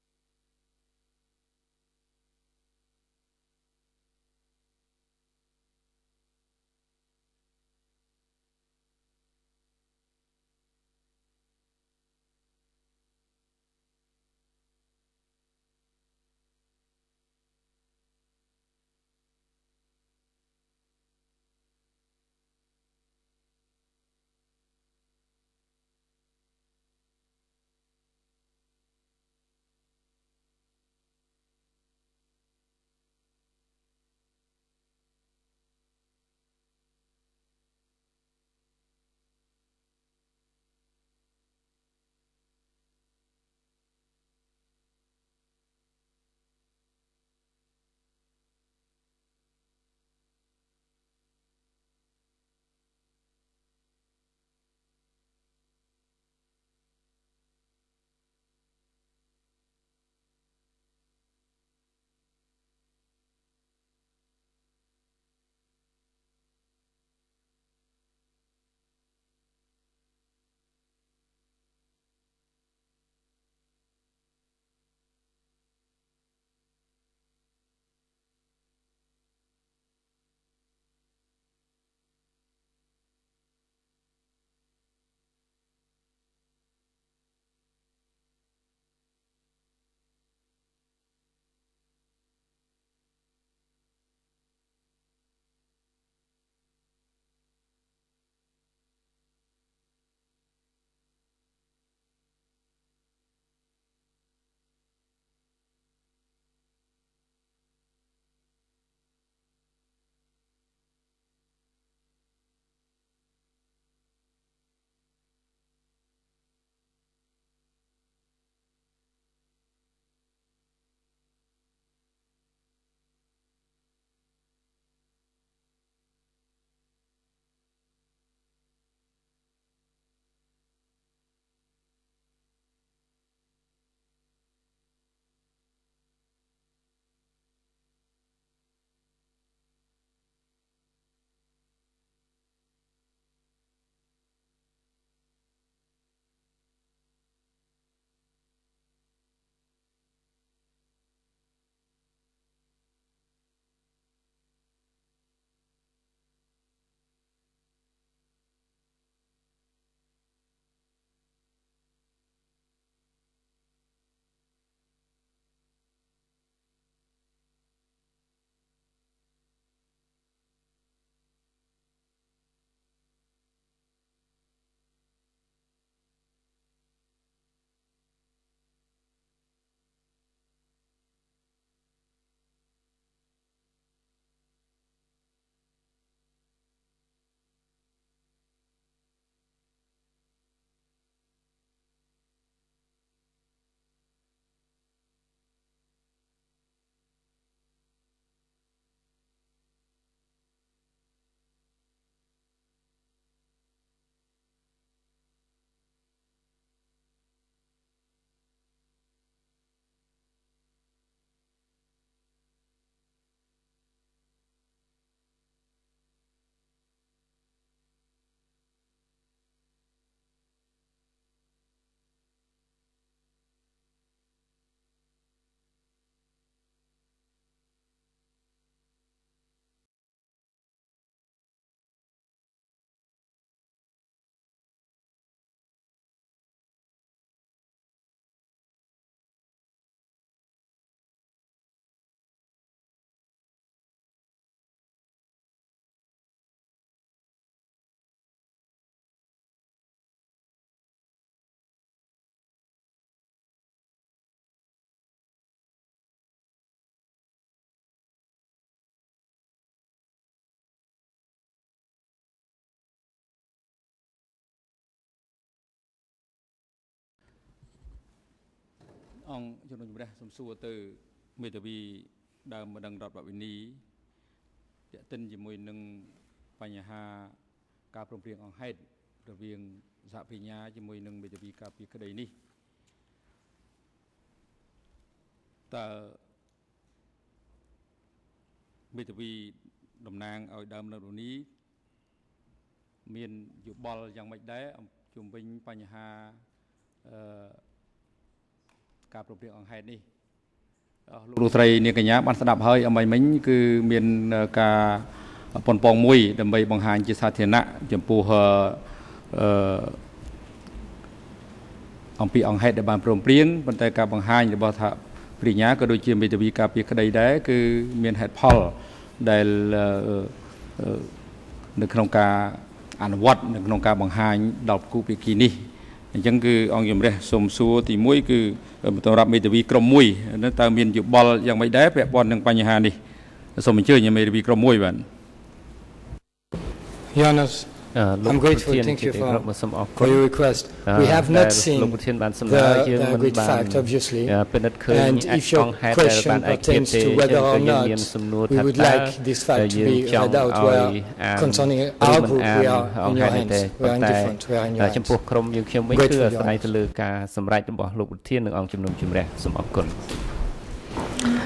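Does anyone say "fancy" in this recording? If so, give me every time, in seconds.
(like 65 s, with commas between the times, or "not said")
not said.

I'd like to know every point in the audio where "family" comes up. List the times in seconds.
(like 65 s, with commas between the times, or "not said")
not said.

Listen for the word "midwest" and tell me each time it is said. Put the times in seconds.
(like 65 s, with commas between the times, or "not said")
not said.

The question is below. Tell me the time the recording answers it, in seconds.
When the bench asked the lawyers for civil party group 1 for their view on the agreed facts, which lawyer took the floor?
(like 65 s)
337 s.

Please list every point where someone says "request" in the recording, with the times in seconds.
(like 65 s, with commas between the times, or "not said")
340 s.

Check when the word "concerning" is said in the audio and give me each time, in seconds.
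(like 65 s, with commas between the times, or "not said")
351 s.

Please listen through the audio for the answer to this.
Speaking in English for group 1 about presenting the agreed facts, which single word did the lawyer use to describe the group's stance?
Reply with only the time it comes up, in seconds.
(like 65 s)
353 s.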